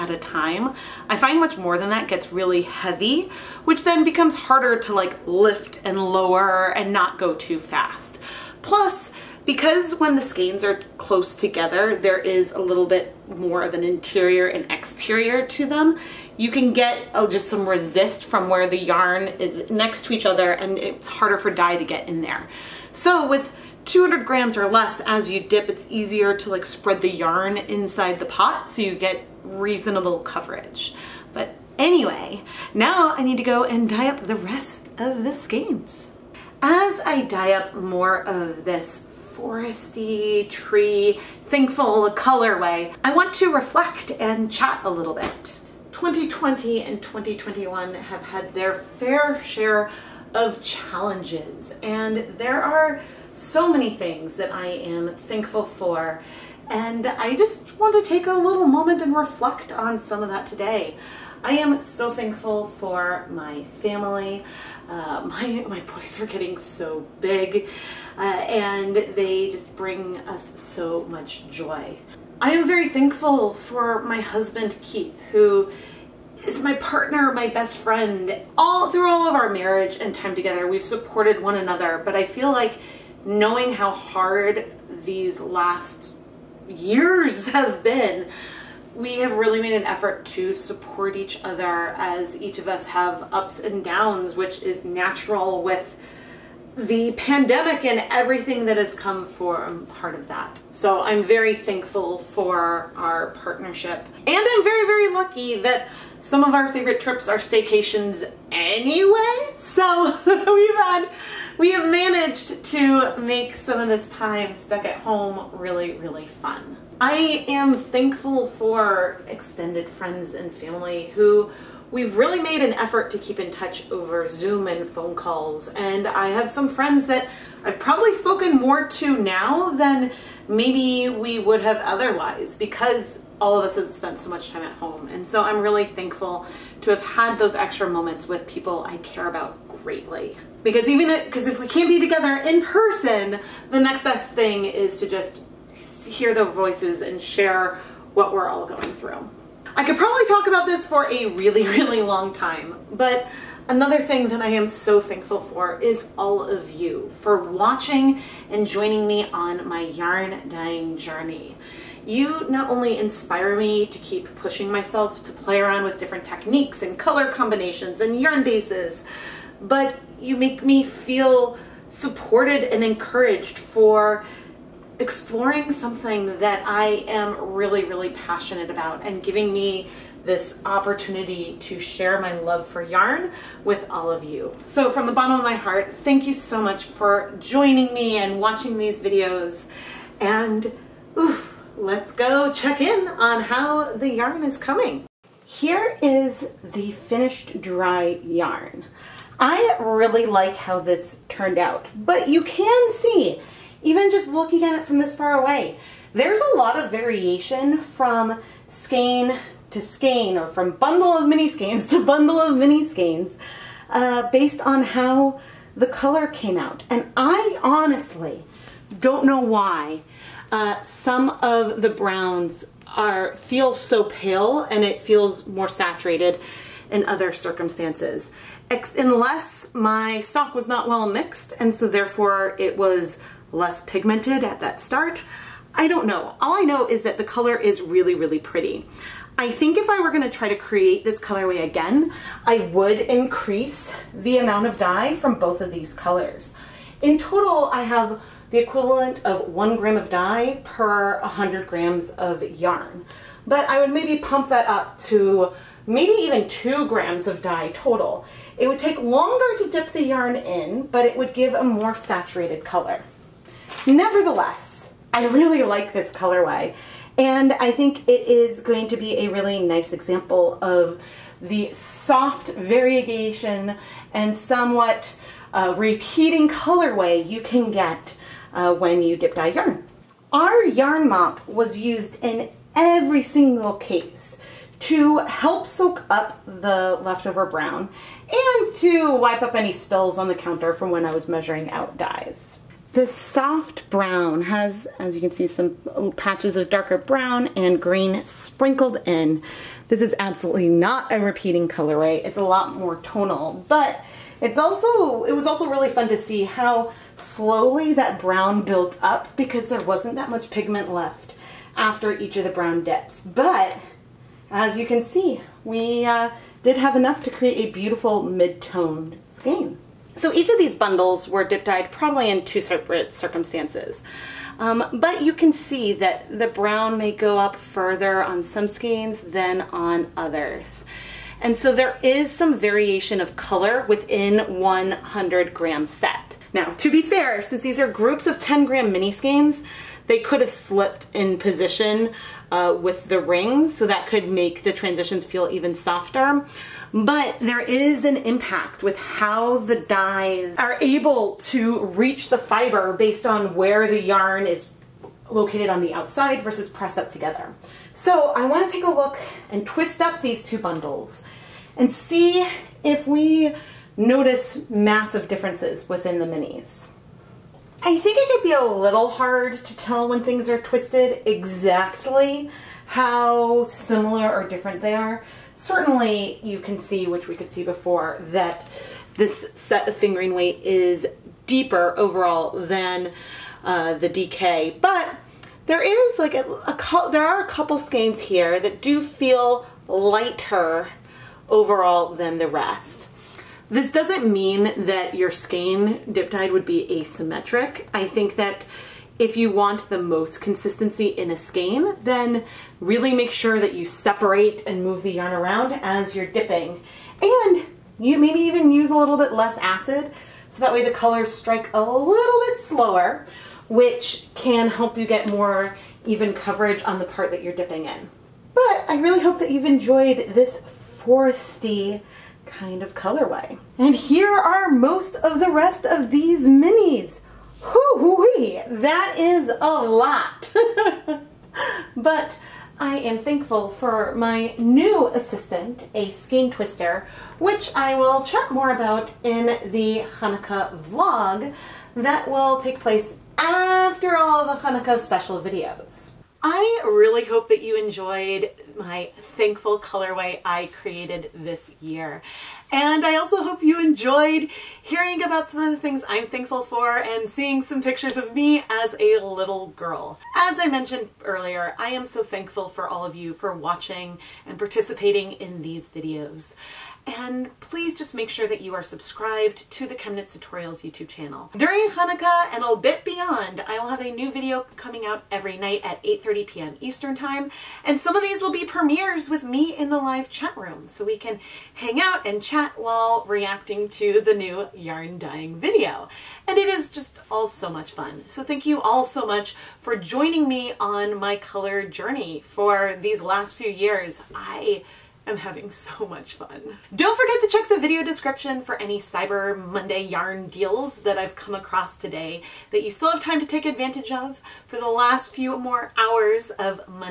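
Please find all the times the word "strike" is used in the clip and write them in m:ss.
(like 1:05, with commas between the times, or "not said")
6:51.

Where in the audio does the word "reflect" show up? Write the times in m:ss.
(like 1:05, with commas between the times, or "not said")
0:43, 0:59.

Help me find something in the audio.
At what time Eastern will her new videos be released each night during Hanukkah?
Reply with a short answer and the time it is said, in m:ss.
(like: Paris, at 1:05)
8:30 p.m., at 7:56.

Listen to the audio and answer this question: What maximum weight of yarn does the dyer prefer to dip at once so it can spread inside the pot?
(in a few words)
200 grams.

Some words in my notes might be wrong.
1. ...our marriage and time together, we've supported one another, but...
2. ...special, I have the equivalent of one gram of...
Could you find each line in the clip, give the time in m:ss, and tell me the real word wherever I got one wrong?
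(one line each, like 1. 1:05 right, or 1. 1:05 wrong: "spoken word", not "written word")
1. 1:19 right
2. 4:07 wrong: "total", not "special".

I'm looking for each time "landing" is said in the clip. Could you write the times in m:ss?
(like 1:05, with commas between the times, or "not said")
not said.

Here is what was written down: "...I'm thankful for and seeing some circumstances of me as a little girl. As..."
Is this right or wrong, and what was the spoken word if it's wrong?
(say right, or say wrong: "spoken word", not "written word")
wrong: "pictures", not "circumstances".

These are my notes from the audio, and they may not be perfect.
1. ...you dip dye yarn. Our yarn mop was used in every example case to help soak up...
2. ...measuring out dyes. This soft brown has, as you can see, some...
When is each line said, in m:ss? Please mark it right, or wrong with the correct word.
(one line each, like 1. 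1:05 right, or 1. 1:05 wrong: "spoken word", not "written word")
1. 4:39 wrong: "single", not "example"
2. 4:51 right.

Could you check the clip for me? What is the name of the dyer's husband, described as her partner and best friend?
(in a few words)
Keith.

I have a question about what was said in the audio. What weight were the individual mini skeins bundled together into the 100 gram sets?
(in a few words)
10 grams.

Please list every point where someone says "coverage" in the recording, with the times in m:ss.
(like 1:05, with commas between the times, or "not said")
0:30, 6:56.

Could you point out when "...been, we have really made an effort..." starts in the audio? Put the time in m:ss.
1:27.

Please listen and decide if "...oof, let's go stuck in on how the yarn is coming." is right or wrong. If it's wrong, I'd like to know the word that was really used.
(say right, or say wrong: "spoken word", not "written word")
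wrong: "check", not "stuck".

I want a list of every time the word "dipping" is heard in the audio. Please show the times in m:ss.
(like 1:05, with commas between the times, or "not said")
6:46, 6:57.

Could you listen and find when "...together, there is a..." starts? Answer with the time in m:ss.
0:11.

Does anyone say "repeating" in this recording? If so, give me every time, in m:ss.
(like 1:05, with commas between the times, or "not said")
4:35, 5:01.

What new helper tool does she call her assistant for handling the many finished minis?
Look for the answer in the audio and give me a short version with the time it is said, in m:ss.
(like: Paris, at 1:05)
Skein twister, at 7:16.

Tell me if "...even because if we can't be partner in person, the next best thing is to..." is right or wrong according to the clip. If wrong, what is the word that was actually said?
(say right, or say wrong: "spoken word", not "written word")
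wrong: "together", not "partner".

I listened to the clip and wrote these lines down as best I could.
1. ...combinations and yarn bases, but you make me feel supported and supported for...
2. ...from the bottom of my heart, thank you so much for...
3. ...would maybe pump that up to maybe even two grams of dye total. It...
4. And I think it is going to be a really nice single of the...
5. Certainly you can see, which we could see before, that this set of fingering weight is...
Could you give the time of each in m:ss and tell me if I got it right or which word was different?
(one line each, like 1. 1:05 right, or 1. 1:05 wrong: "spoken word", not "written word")
1. 2:47 wrong: "encouraged", not "supported"
2. 3:04 right
3. 4:13 right
4. 4:27 wrong: "example", not "single"
5. 6:15 right.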